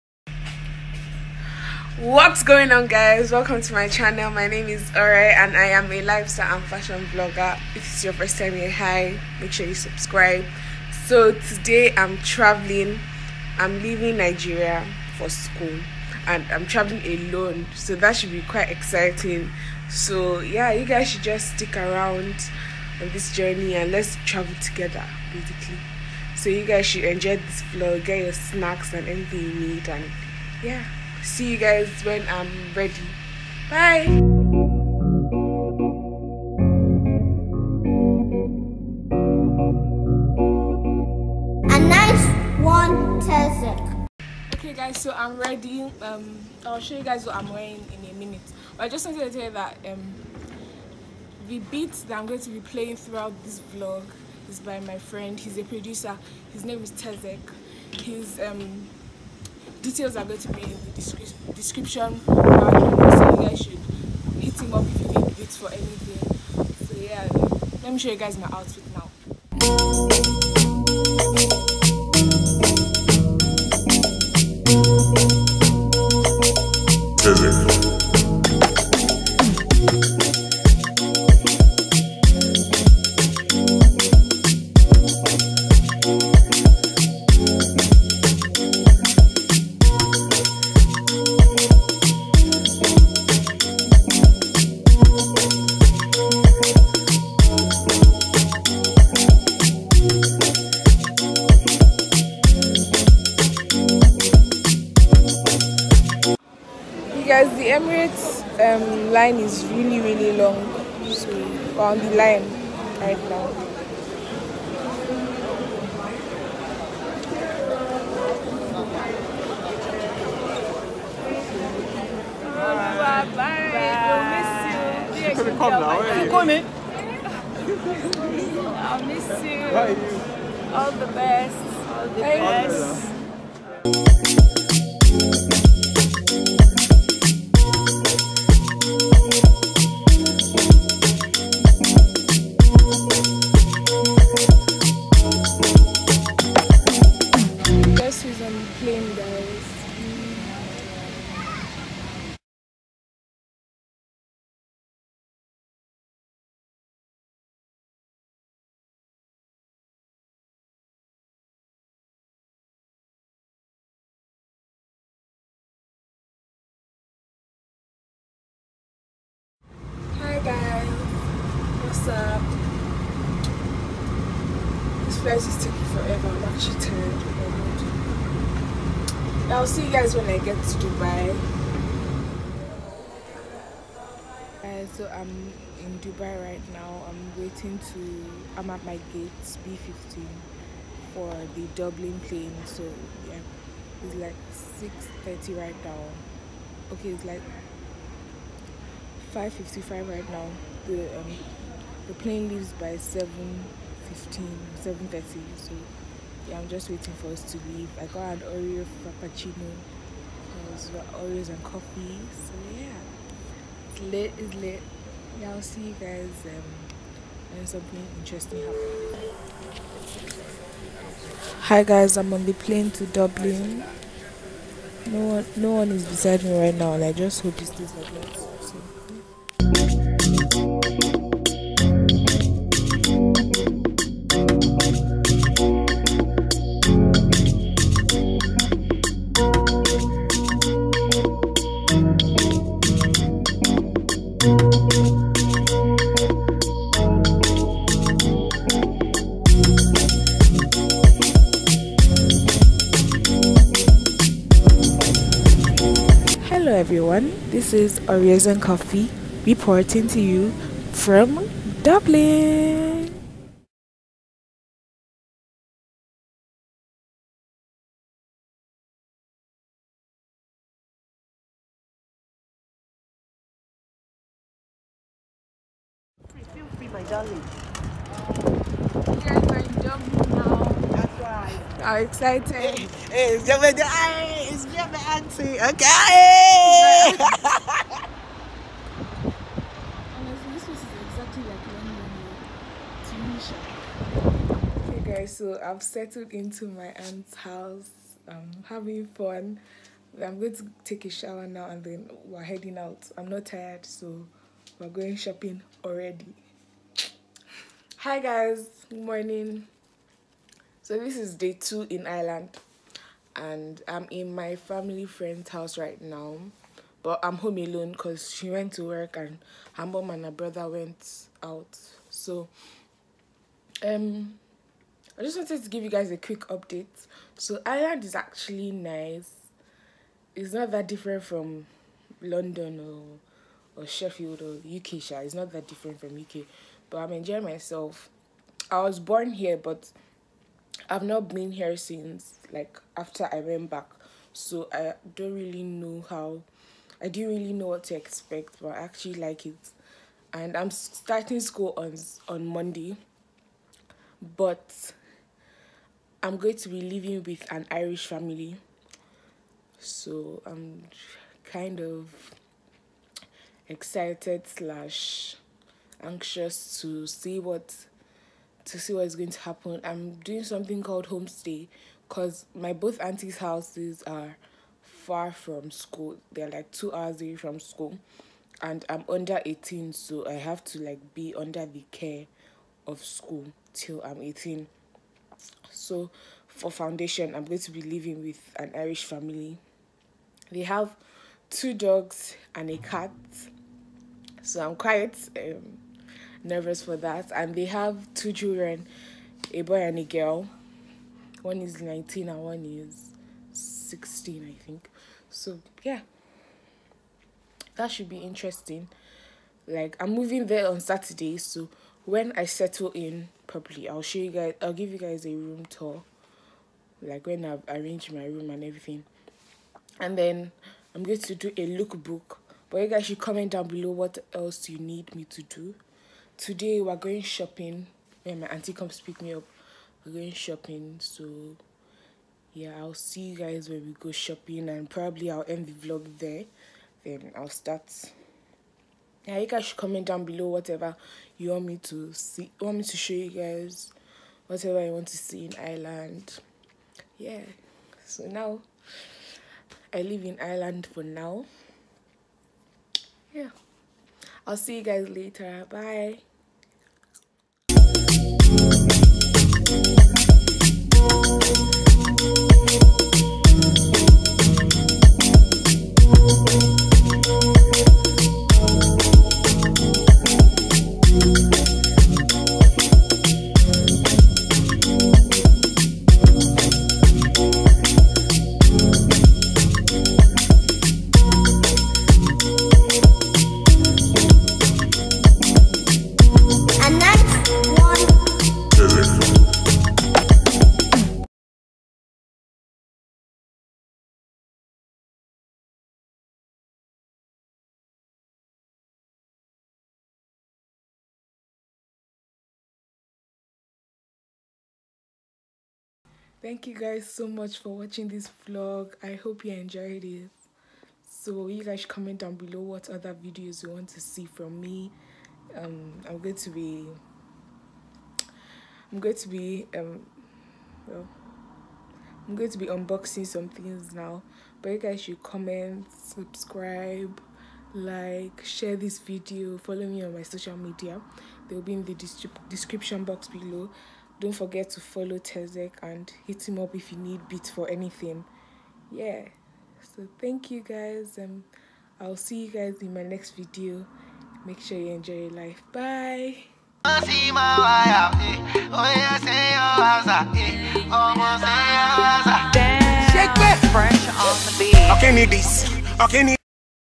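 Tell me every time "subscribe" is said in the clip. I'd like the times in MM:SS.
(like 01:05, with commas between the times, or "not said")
00:09, 08:45.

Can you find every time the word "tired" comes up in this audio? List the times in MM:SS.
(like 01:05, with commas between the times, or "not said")
02:56, 05:03.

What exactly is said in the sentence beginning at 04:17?
This is Oreos and Coffee reporting to you from Dublin.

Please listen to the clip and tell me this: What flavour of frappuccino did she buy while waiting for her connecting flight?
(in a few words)
Oreo.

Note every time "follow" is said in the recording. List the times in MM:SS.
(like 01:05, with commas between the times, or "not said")
08:49, 08:54.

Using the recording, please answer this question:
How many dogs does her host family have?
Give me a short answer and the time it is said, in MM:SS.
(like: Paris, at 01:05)
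2, at 06:31.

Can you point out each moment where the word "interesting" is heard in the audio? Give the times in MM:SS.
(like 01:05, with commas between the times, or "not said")
03:38, 06:48.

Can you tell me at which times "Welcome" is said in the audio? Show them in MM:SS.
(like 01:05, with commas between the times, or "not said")
00:03.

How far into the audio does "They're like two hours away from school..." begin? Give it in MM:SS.
06:16.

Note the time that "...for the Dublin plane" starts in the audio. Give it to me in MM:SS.
03:11.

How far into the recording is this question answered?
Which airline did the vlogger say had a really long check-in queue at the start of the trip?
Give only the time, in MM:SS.
01:47.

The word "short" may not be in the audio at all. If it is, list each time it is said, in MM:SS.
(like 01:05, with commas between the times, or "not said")
not said.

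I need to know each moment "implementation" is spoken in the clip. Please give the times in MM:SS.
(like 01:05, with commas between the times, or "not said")
not said.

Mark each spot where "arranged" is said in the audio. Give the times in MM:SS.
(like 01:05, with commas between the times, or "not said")
06:57.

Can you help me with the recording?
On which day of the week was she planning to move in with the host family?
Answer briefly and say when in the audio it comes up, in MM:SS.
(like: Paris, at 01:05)
Saturday, at 06:50.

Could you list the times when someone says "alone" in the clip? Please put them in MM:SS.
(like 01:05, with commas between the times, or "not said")
00:17, 05:17.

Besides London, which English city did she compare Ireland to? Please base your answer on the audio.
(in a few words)
Sheffield.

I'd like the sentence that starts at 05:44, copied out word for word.
So I don't really know how, I didn't really know what to expect, but I actually like it.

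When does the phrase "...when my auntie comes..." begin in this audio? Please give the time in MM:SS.
07:08.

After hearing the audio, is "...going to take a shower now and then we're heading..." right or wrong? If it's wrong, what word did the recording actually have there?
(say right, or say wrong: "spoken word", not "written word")
right.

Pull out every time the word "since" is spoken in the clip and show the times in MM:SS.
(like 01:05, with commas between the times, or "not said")
05:41.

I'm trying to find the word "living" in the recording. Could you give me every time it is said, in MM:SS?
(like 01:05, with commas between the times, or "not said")
05:56, 06:27.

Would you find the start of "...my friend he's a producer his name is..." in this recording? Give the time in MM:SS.
00:54.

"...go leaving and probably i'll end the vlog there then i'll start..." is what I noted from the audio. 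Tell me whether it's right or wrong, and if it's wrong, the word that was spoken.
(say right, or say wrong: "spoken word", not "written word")
wrong: "shopping", not "leaving".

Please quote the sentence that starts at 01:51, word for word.
So we're on the line right now.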